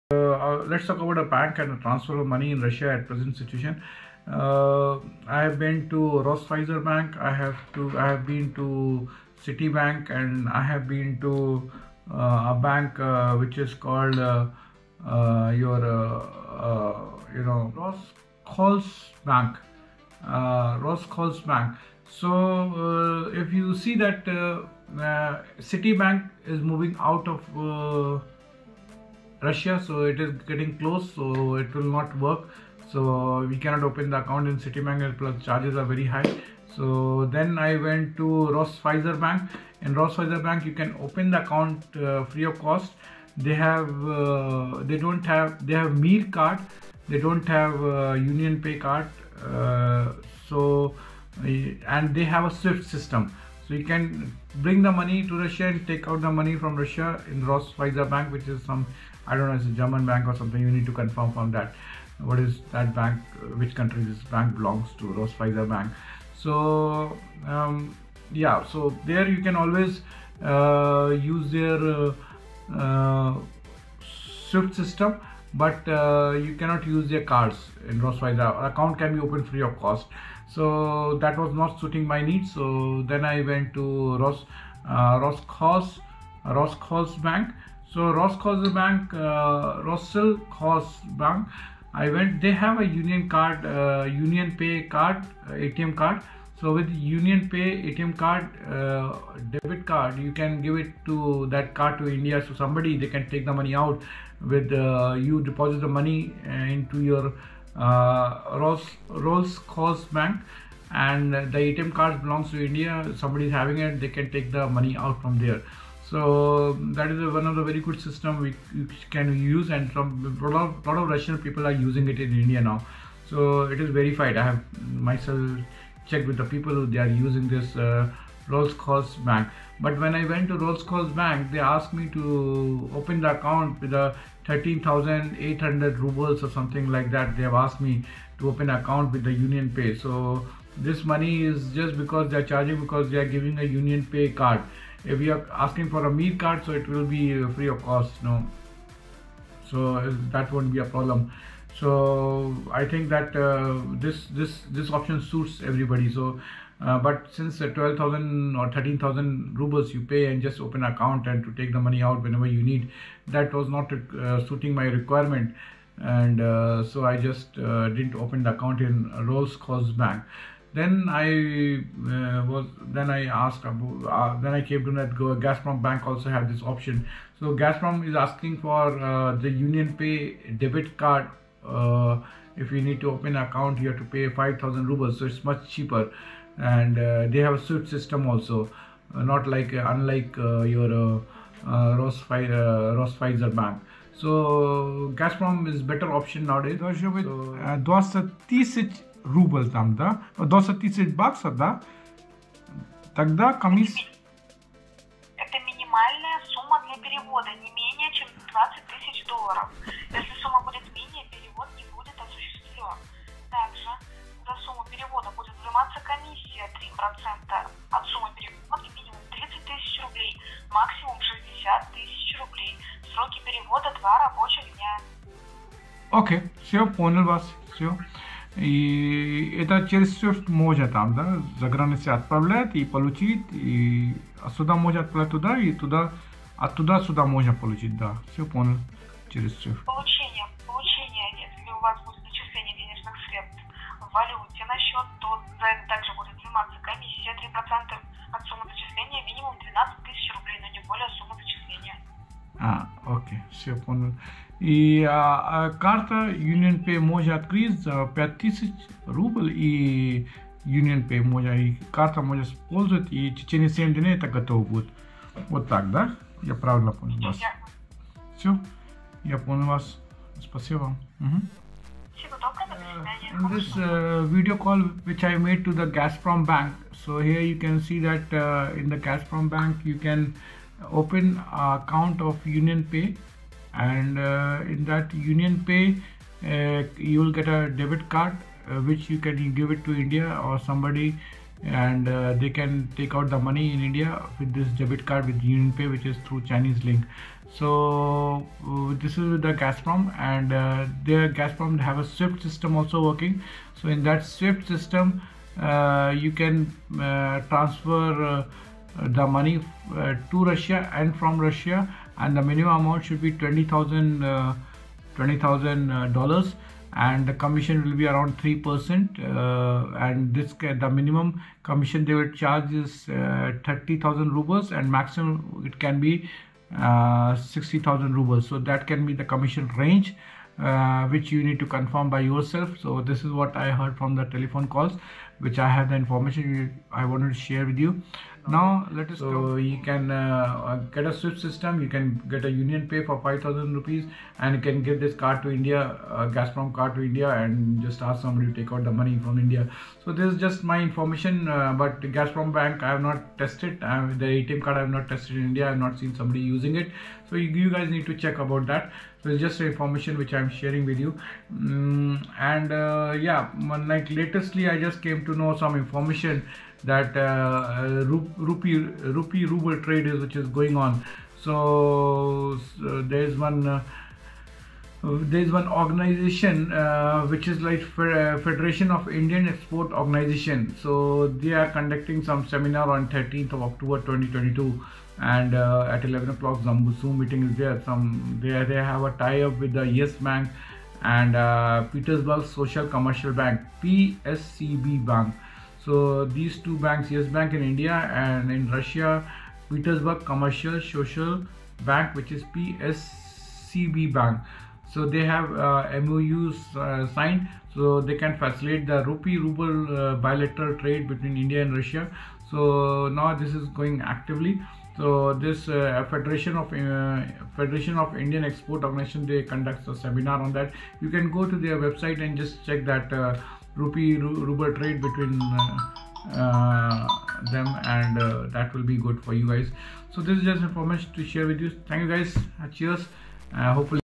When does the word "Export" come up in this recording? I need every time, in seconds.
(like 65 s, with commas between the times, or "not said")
379 s, 418 s.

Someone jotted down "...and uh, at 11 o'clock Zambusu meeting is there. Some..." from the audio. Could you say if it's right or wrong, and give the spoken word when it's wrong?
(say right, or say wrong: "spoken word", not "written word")
right.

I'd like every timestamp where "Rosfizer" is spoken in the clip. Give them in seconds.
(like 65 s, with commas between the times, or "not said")
6 s, 65 s, 78 s, 191 s.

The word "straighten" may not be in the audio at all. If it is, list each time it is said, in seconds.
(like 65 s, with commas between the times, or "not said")
not said.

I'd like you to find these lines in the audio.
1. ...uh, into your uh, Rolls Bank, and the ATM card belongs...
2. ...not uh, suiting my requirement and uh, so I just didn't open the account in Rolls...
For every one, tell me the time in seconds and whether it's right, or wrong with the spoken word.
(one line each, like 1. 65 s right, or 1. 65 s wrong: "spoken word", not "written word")
1. 106 s right
2. 163 s right.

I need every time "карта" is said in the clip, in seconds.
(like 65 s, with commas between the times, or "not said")
255 s, 261 s.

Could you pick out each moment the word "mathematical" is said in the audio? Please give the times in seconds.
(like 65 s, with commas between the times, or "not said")
not said.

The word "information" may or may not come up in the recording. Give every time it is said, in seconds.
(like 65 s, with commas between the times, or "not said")
335 s, 350 s, 359 s, 365 s, 430 s.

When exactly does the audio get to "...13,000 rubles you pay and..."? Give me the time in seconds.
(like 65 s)
158 s.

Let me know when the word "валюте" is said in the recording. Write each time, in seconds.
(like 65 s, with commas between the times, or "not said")
244 s.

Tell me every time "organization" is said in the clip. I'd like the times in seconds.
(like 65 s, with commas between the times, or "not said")
375 s, 379 s, 418 s.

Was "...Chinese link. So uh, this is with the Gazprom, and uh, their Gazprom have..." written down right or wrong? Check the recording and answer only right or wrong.
right.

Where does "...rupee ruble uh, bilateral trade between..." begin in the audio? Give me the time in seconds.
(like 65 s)
409 s.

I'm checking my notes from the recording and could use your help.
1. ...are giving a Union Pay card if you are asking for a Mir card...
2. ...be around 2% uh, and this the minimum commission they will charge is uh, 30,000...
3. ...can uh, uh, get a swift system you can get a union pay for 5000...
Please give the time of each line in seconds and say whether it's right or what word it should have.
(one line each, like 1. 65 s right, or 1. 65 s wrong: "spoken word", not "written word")
1. 143 s right
2. 317 s wrong: "3", not "2"
3. 339 s right.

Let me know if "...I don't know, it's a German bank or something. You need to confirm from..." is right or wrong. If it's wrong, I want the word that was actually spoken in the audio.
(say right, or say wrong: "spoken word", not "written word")
right.